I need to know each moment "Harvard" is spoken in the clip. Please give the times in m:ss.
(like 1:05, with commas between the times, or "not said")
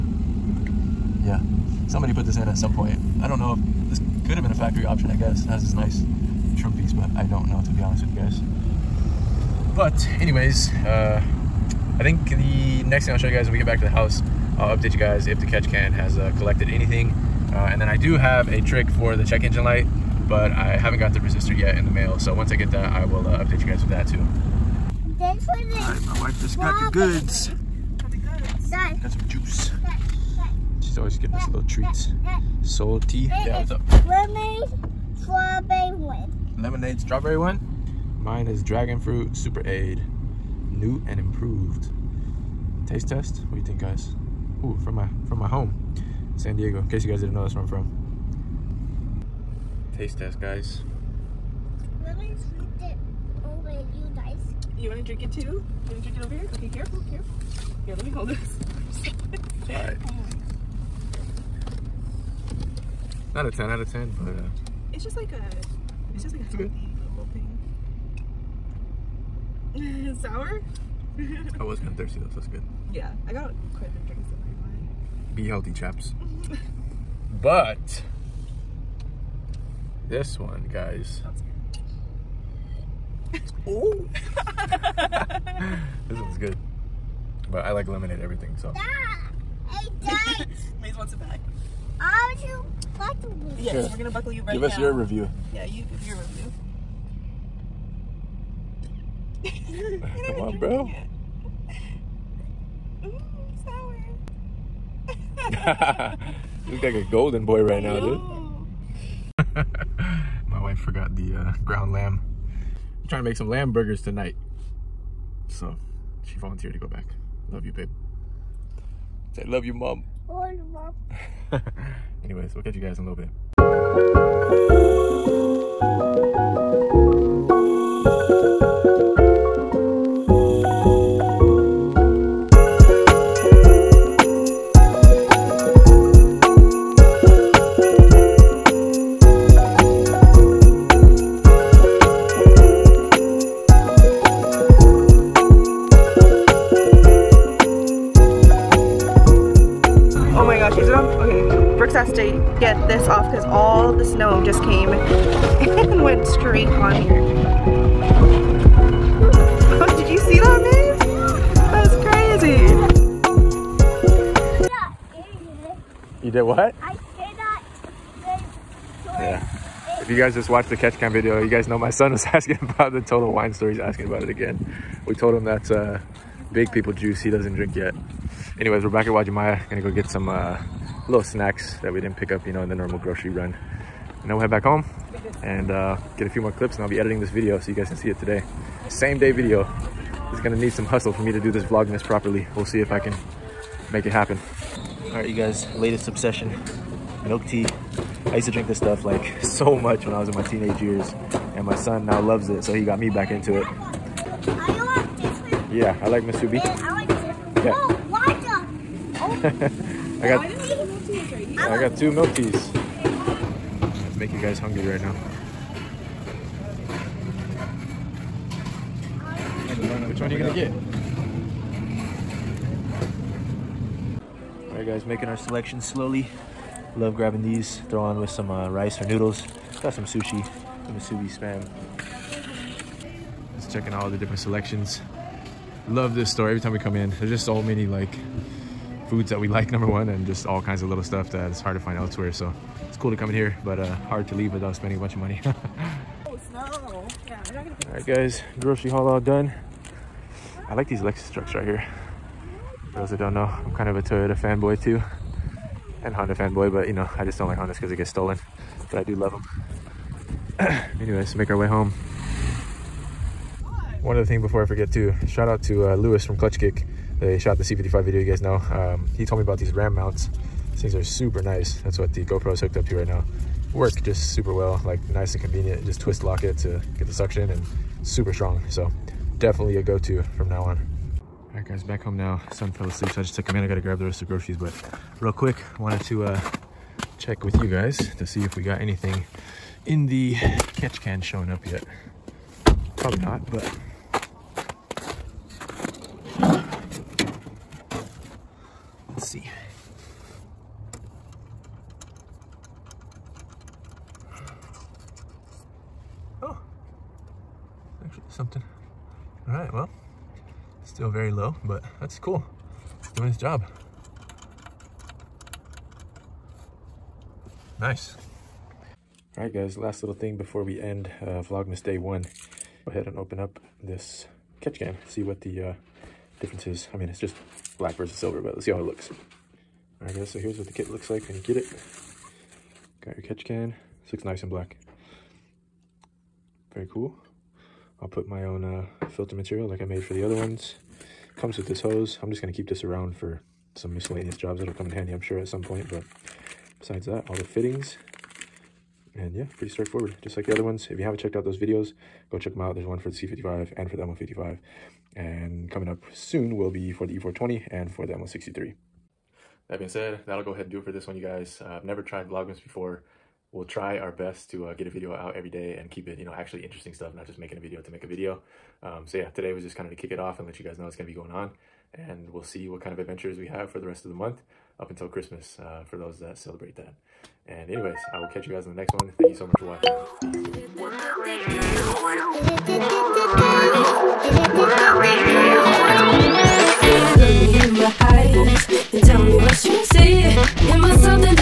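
not said.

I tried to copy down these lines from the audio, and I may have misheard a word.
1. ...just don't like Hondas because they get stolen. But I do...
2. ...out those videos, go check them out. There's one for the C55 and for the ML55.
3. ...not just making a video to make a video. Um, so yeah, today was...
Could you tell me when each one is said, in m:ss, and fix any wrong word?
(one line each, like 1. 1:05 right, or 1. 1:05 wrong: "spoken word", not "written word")
1. 4:17 right
2. 5:51 right
3. 6:07 right.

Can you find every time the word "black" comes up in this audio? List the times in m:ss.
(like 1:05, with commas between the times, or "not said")
5:27, 5:34.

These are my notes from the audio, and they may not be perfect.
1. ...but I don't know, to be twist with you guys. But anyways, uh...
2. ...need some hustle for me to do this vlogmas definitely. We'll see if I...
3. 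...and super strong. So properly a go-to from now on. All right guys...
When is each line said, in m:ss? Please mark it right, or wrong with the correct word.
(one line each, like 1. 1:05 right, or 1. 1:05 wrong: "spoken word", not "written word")
1. 0:06 wrong: "honest", not "twist"
2. 3:10 wrong: "properly", not "definitely"
3. 4:37 wrong: "definitely", not "properly".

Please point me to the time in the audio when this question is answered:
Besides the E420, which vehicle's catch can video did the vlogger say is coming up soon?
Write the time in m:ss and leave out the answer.
5:58.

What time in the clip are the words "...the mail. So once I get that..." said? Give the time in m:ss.
0:21.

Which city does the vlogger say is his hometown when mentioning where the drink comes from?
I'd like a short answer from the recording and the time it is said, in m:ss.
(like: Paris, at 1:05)
San Diego, at 0:46.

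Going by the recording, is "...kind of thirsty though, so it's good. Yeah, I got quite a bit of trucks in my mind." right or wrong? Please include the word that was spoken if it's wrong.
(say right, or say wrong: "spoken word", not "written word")
wrong: "drinks", not "trucks".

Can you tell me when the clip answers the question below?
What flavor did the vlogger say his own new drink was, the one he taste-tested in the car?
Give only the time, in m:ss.
0:38.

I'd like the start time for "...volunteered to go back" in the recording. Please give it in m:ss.
1:56.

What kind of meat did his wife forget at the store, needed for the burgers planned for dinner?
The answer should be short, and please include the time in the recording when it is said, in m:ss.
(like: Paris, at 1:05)
Ground lamb, at 1:51.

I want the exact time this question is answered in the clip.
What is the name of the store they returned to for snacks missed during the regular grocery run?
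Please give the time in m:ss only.
2:59.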